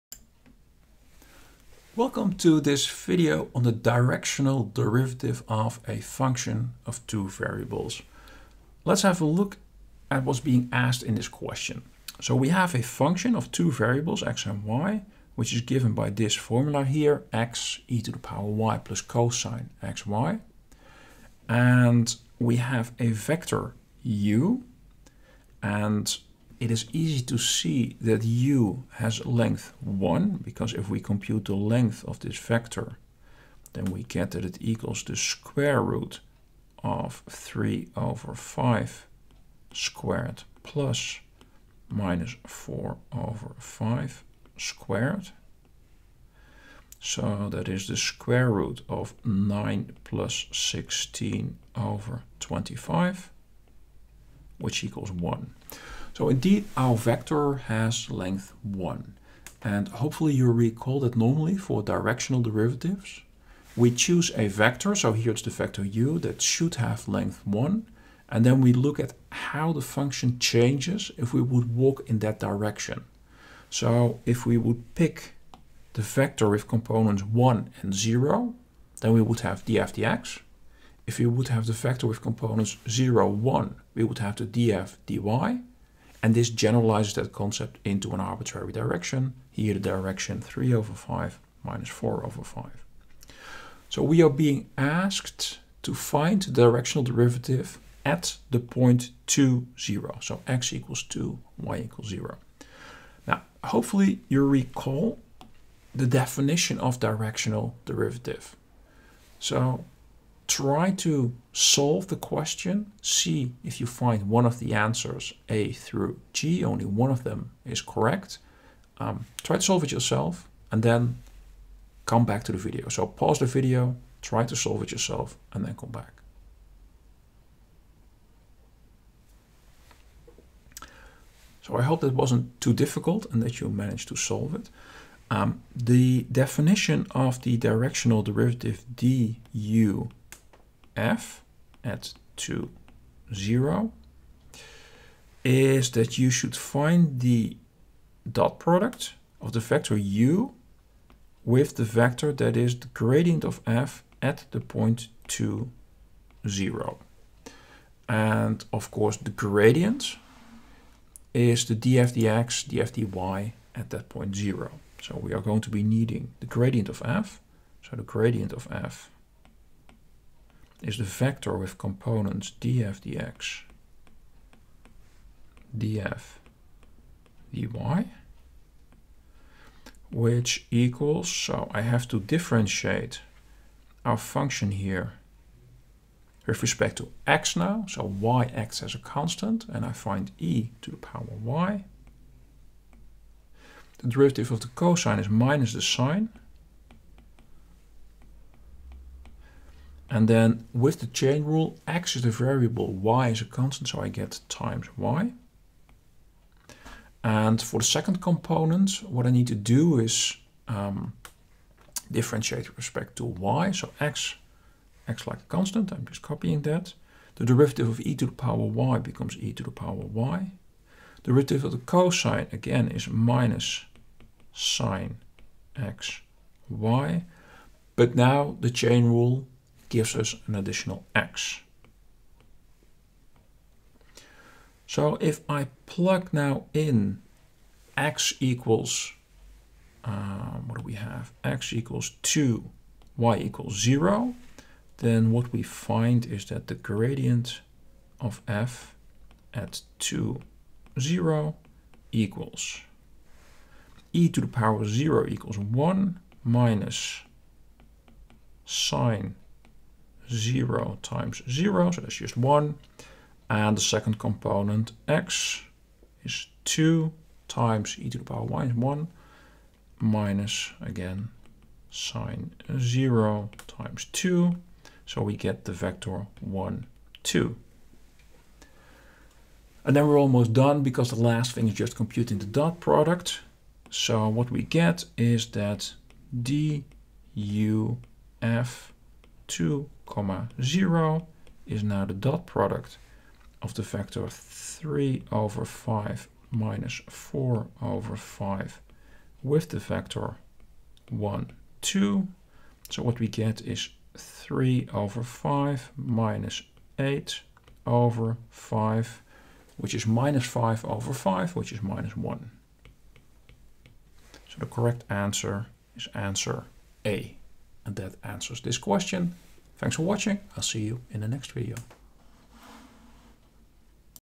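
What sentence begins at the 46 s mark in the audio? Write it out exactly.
So that is the square root of 9 plus 16 over 25, which equals 1.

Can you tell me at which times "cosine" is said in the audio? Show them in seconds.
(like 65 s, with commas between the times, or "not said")
19 s, 194 s, 221 s.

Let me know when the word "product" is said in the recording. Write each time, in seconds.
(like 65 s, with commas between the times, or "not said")
148 s, 282 s, 292 s.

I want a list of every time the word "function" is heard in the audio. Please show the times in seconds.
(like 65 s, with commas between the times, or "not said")
5 s, 12 s, 69 s, 184 s.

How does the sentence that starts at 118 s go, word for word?
Um, try to solve it yourself and then come back to the video.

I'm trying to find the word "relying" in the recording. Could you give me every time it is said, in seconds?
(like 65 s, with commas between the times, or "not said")
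not said.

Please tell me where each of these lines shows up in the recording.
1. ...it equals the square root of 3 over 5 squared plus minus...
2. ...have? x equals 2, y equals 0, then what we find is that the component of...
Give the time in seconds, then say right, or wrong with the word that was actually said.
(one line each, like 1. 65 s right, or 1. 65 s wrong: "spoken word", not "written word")
1. 34 s right
2. 240 s wrong: "gradient", not "component".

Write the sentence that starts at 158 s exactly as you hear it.
And of course the gradient is the df dx, df dy at that point 0.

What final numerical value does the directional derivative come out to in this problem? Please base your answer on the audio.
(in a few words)
-1.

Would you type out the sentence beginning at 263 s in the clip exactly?
And the second component, x, is 2 times e to the power y, is 1 minus, again, sine 0 times 2.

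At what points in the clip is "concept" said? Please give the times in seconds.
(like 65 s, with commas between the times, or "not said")
87 s.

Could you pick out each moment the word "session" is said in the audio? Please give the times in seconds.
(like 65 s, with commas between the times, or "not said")
not said.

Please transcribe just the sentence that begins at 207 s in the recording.
And for the second component, what I need to do is um, differentiate with respect to y.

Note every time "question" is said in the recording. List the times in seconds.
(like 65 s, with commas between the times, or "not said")
11 s, 112 s, 318 s.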